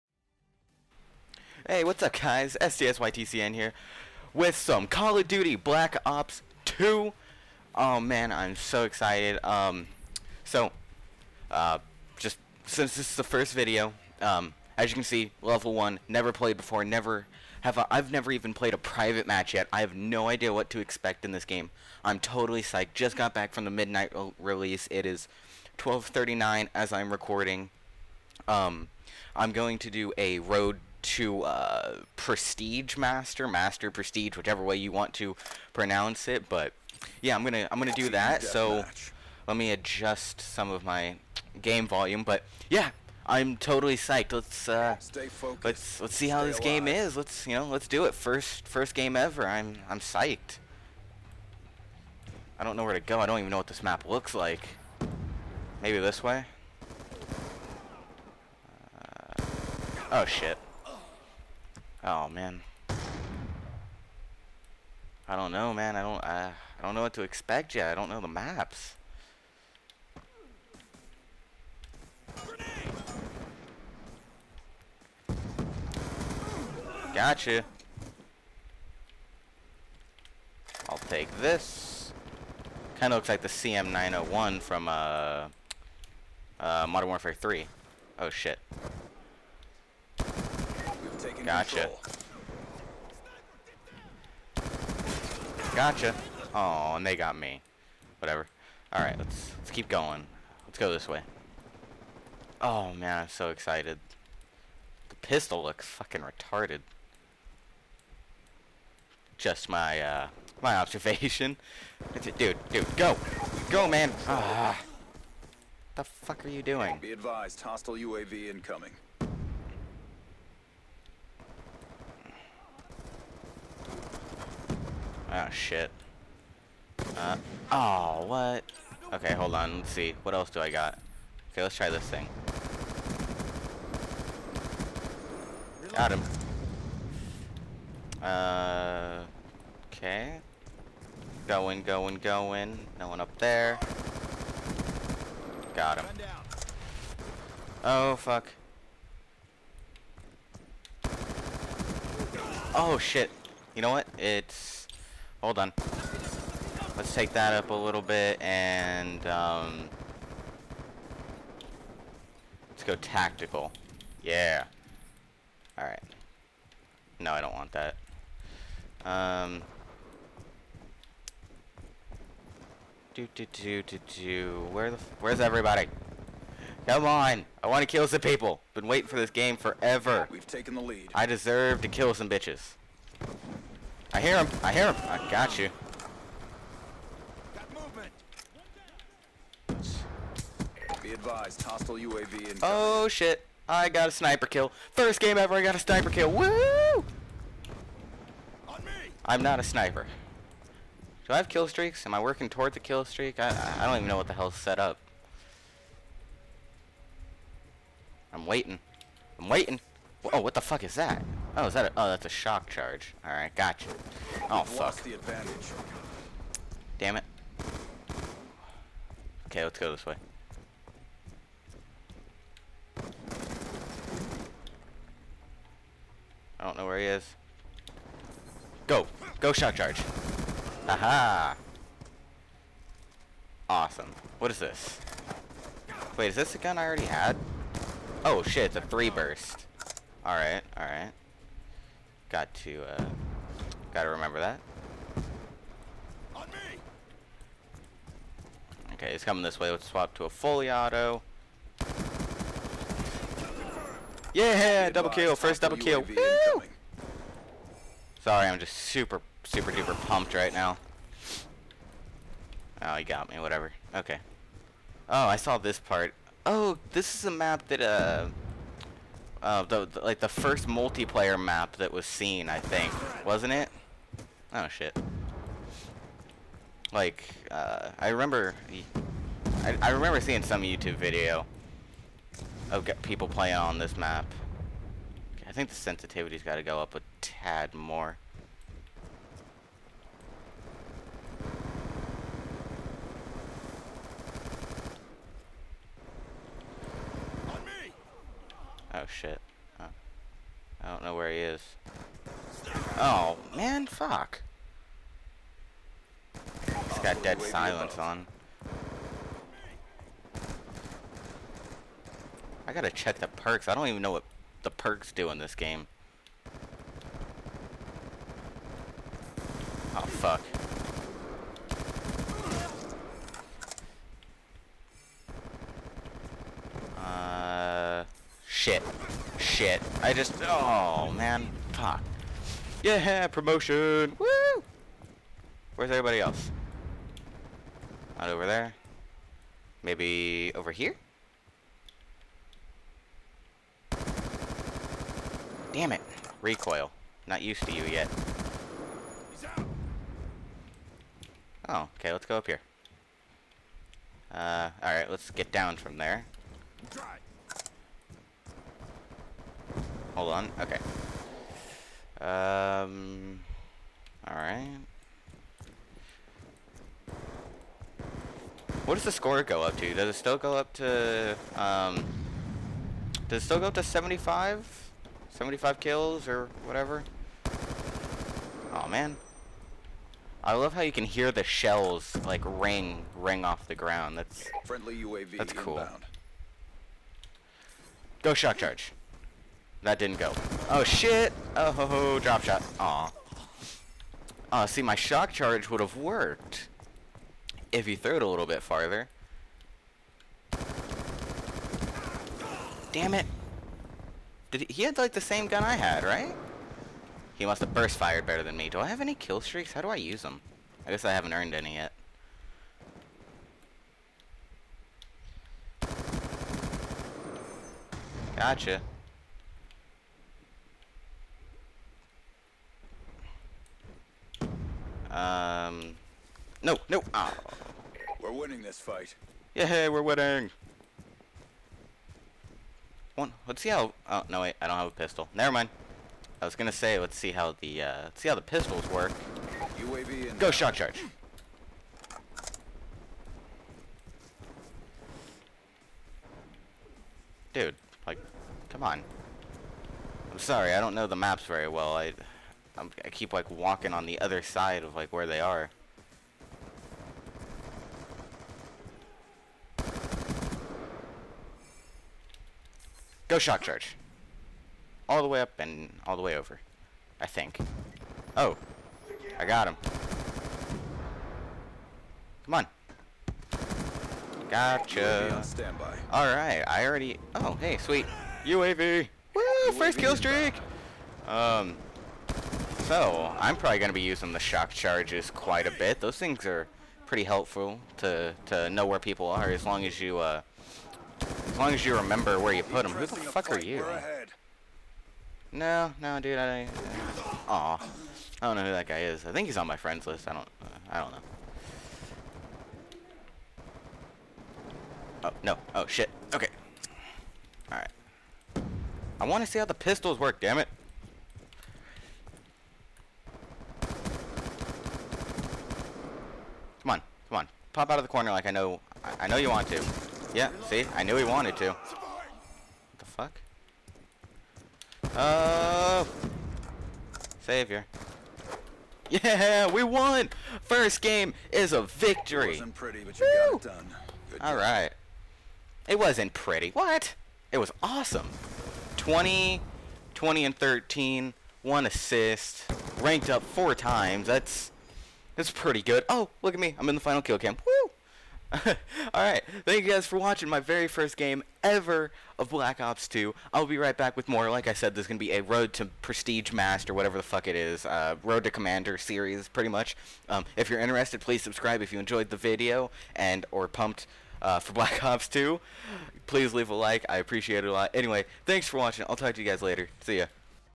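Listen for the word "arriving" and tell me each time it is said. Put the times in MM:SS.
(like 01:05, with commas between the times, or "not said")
not said.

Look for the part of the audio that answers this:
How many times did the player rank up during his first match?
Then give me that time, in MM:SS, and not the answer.
09:03.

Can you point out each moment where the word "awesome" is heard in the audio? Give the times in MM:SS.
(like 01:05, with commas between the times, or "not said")
03:53, 08:57.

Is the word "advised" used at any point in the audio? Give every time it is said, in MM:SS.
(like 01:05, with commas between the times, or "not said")
01:57, 03:11.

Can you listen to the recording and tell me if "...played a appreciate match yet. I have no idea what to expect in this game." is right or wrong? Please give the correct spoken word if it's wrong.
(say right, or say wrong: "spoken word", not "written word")
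wrong: "private", not "appreciate".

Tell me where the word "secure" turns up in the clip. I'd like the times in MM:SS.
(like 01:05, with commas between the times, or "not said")
not said.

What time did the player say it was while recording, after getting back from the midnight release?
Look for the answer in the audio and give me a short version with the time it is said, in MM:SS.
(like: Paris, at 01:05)
12:39, at 00:25.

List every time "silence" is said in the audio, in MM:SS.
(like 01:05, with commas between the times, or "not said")
05:07.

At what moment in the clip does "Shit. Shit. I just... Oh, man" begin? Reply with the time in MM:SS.
05:28.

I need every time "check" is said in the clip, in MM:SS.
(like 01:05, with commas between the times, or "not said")
05:12.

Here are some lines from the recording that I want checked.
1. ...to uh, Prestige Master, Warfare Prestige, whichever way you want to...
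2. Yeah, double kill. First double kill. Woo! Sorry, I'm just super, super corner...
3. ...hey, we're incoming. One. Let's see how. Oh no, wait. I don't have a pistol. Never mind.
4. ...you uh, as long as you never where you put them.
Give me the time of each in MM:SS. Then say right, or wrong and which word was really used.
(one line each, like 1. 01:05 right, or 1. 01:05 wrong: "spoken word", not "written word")
1. 00:31 wrong: "Master", not "Warfare"
2. 04:14 wrong: "duper", not "corner"
3. 07:09 wrong: "winning", not "incoming"
4. 08:10 wrong: "remember", not "never".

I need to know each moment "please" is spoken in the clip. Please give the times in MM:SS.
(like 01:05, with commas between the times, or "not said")
09:21, 09:26.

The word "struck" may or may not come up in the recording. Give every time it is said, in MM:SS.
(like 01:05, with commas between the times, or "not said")
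not said.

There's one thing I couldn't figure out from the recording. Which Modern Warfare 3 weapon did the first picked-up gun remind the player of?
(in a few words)
CM901.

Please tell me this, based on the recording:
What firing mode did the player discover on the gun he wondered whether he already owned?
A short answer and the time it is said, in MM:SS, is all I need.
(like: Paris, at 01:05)
Three burst, at 03:58.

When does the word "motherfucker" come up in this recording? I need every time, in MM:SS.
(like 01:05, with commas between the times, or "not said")
not said.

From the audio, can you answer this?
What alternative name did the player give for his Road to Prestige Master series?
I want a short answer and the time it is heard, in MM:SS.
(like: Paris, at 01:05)
Road to Commander, at 09:18.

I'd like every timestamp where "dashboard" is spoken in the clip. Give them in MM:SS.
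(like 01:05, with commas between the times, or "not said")
not said.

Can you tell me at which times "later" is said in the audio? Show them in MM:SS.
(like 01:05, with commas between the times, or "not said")
09:29.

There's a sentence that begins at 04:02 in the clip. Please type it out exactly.
Got to, uh, gotta remember that.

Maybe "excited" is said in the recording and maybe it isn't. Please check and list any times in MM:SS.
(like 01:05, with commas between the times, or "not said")
00:08, 01:43.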